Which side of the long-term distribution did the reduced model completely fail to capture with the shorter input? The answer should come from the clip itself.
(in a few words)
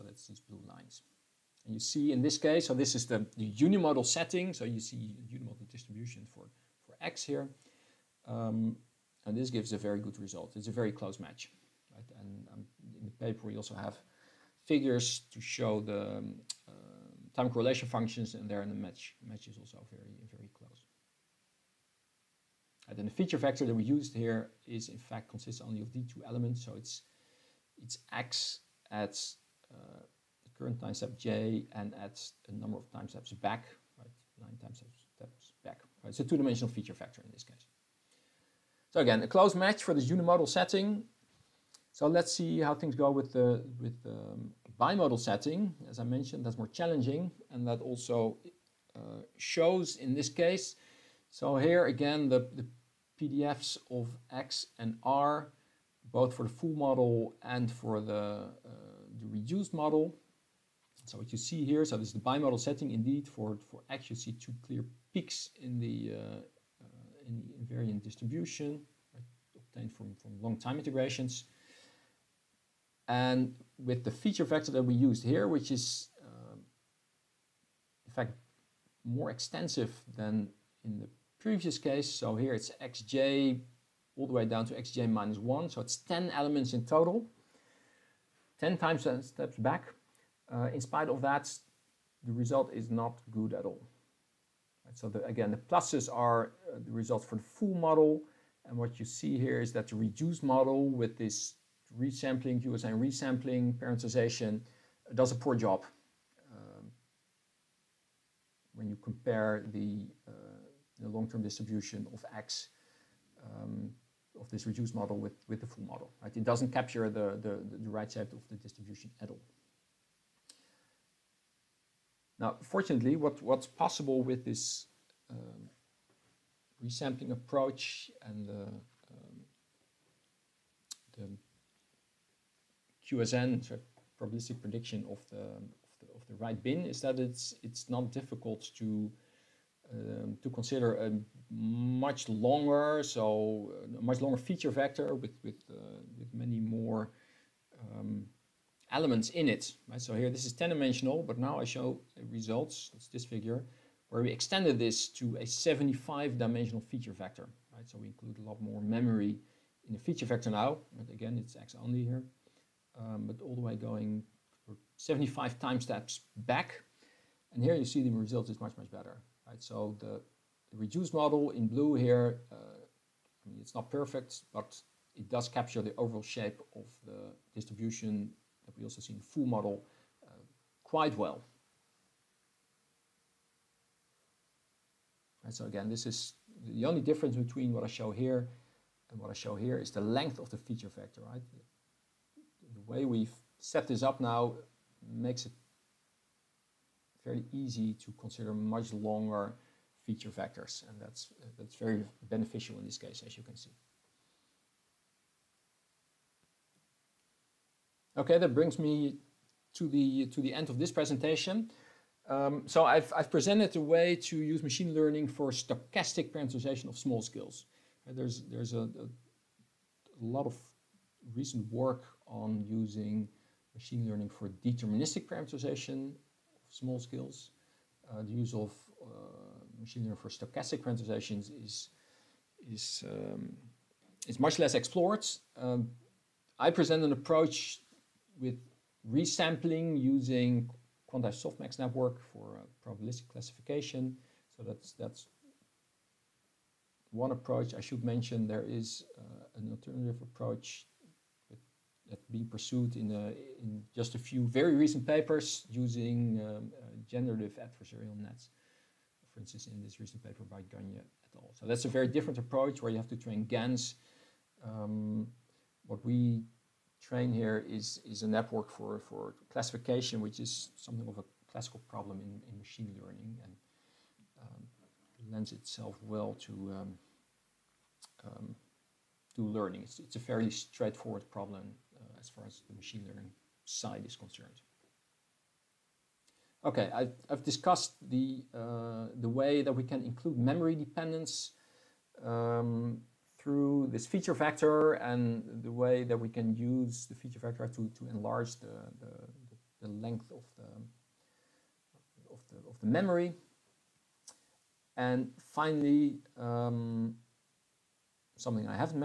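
The right side.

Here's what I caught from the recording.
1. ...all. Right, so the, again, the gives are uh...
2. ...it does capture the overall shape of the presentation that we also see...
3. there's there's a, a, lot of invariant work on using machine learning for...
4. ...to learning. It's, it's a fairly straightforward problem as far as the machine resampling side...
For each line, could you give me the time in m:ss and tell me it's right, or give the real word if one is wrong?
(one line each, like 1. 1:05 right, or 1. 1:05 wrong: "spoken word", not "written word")
1. 1:33 wrong: "pluses", not "gives"
2. 2:55 wrong: "distribution", not "presentation"
3. 3:38 wrong: "recent", not "invariant"
4. 4:39 wrong: "learning", not "resampling".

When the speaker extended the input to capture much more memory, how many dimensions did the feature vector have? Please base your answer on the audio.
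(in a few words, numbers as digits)
75.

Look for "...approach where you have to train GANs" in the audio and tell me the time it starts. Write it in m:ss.
4:22.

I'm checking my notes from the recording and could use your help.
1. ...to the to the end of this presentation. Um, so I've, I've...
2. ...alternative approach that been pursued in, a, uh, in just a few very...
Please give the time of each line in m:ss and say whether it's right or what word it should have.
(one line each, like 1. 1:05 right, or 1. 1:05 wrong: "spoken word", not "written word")
1. 3:29 right
2. 4:09 right.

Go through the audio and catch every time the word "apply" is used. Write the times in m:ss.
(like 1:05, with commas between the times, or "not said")
not said.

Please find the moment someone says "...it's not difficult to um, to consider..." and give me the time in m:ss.
2:17.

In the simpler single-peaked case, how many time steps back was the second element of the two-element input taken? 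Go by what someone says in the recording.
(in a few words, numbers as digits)
9.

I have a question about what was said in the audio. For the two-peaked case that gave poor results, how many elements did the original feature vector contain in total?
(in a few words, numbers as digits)
10.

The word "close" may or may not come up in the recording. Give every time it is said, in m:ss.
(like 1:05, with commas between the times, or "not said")
0:10, 0:20, 0:39.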